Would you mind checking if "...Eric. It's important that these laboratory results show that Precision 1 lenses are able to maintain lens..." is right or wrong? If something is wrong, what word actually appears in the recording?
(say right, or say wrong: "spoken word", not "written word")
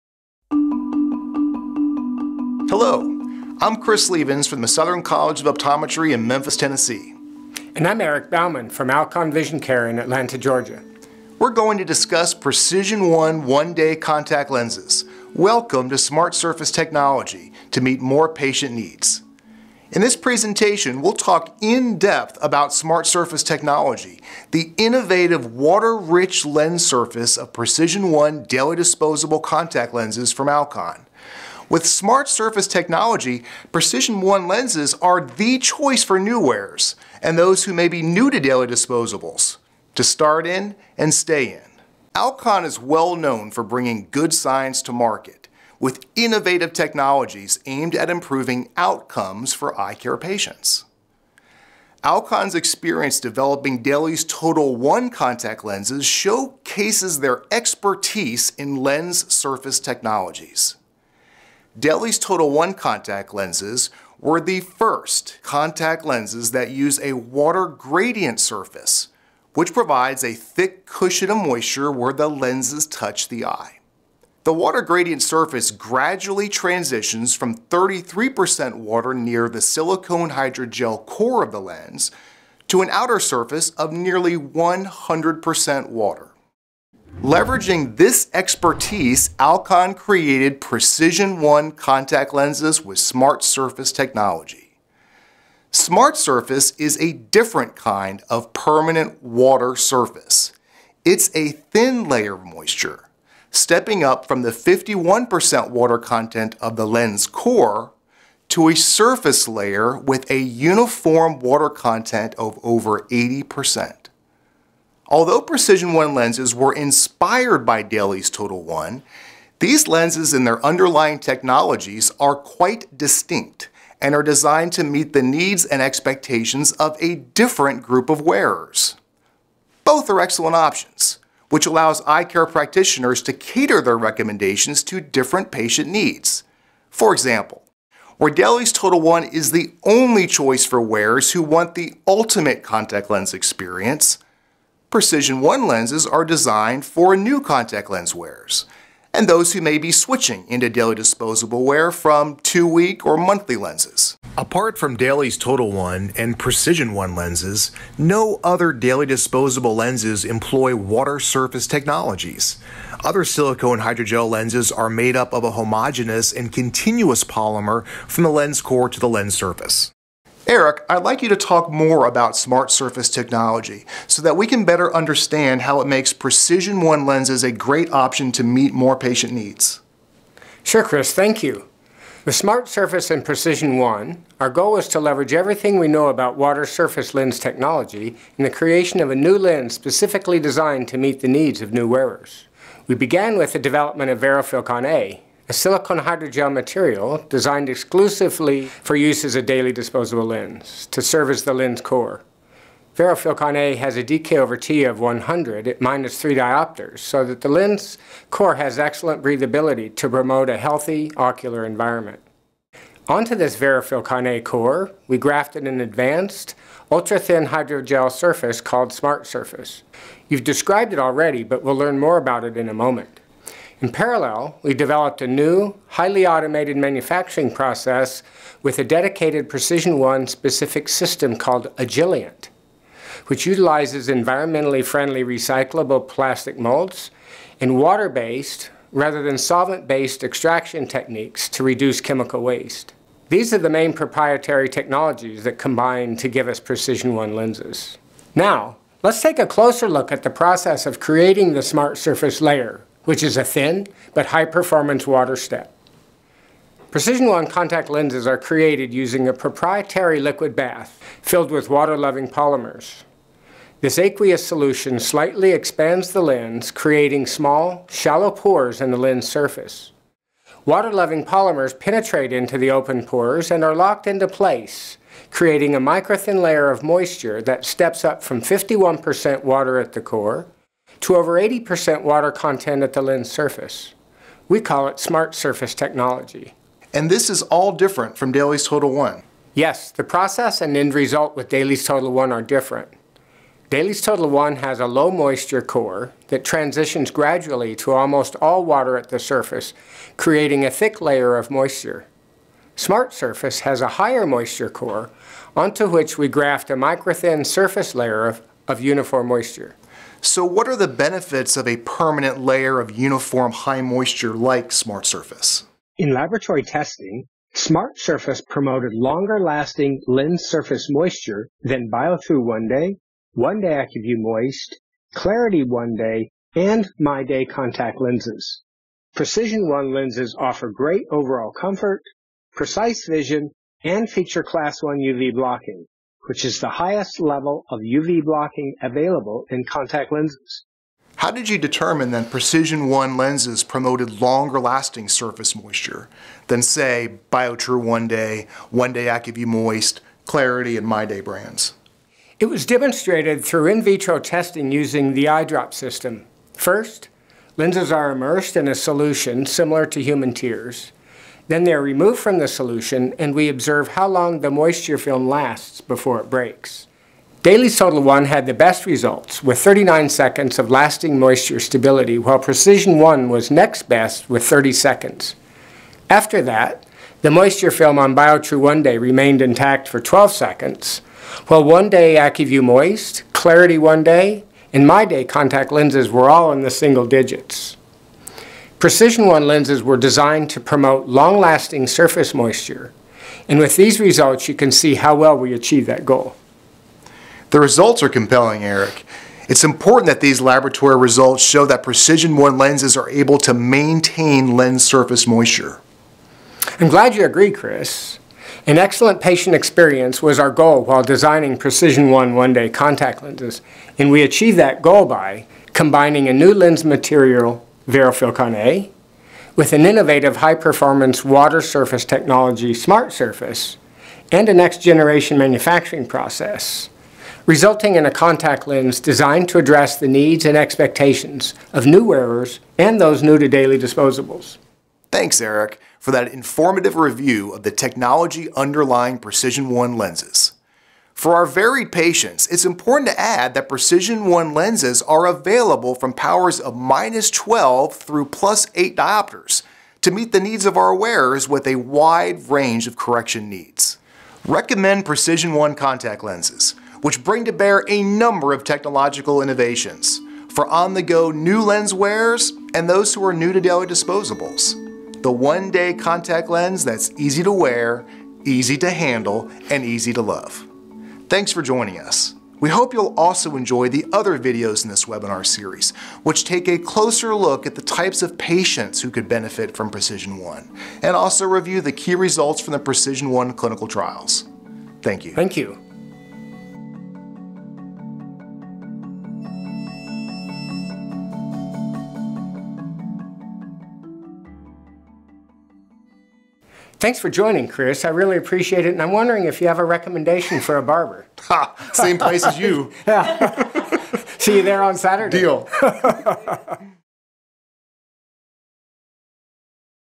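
right.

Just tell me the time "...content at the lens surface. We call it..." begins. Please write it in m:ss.
4:42.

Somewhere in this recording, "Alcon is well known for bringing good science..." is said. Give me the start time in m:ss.
0:42.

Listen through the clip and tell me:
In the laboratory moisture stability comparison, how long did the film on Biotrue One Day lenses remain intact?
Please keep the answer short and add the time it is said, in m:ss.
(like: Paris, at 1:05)
12 seconds, at 6:19.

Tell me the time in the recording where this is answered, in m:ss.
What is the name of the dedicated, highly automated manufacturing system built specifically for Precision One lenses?
3:51.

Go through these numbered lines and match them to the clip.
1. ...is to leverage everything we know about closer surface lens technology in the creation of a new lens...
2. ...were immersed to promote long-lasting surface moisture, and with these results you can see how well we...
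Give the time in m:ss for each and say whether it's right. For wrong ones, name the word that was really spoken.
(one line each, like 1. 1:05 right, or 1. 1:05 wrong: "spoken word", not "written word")
1. 3:04 wrong: "water", not "closer"
2. 6:29 wrong: "designed", not "immersed".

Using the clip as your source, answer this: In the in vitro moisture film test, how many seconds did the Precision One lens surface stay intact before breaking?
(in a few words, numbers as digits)
30 seconds.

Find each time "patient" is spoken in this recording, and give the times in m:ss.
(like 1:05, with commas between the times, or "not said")
0:18, 0:50, 2:15, 2:58, 6:49, 7:21, 7:58.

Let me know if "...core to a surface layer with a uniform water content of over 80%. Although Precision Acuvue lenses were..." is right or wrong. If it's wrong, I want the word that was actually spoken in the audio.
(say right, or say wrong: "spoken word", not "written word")
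wrong: "One", not "Acuvue".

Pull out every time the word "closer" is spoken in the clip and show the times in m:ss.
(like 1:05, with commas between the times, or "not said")
4:09, 7:56.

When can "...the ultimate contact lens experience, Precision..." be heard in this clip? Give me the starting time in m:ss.
2:21.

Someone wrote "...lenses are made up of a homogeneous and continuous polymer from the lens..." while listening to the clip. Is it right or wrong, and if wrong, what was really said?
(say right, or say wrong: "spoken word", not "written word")
right.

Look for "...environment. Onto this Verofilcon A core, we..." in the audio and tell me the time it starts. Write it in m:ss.
3:31.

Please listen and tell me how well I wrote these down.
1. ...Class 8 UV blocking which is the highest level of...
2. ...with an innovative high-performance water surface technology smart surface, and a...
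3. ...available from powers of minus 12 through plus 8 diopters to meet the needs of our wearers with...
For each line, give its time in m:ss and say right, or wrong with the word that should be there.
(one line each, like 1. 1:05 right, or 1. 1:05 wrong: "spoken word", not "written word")
1. 5:34 wrong: "1", not "8"
2. 6:59 right
3. 7:25 right.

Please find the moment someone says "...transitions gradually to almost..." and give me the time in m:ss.
4:56.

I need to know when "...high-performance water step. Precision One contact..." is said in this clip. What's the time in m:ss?
4:14.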